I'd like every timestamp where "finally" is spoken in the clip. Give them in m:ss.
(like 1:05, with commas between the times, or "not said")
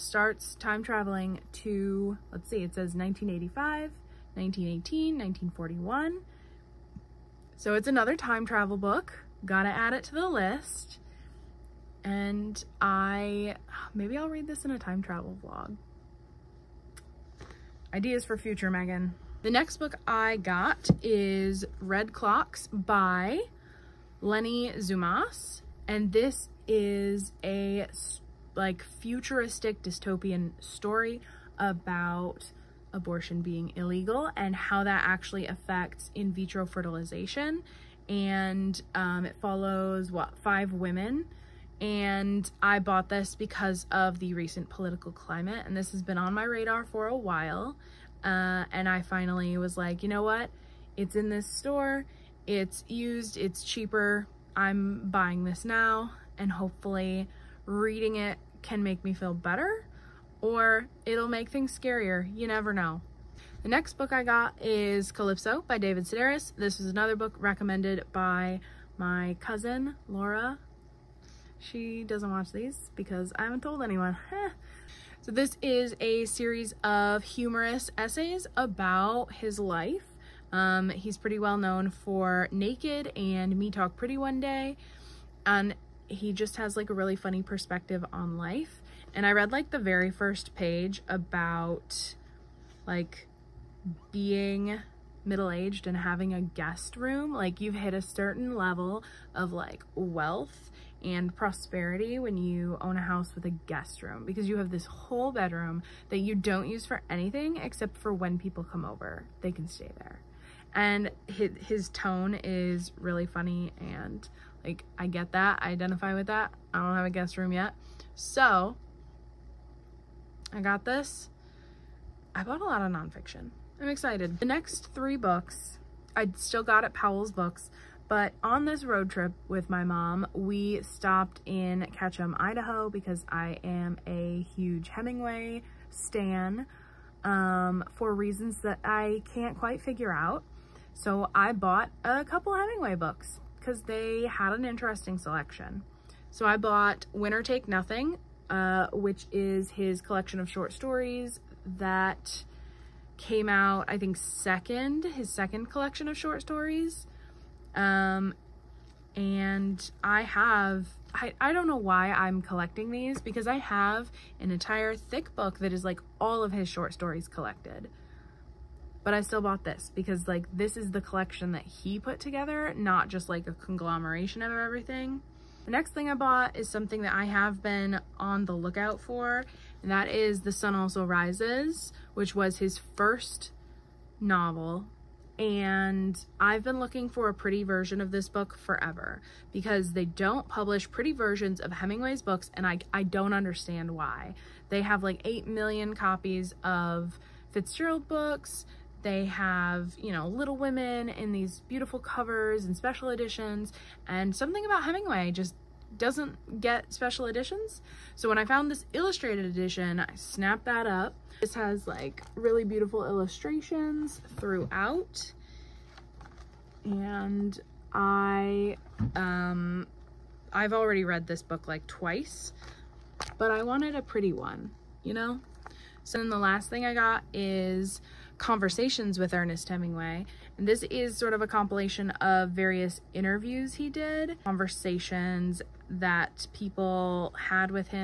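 0:49.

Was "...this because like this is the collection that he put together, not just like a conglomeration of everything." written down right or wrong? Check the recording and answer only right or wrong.
right.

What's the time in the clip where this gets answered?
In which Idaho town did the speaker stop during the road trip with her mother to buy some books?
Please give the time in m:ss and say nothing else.
2:11.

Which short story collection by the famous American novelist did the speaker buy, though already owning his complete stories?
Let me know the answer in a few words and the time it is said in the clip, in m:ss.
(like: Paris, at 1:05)
Winner Take Nothing, at 2:27.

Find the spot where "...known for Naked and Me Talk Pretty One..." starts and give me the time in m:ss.
1:21.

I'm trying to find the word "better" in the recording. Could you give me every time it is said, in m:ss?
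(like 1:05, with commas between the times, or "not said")
0:59.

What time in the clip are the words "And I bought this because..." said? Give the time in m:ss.
0:41.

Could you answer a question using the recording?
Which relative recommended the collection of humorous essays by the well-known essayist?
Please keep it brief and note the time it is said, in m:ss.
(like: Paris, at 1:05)
Laura, at 1:10.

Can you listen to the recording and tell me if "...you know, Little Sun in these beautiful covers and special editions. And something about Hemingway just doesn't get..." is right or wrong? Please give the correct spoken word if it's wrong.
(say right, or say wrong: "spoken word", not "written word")
wrong: "Women", not "Sun".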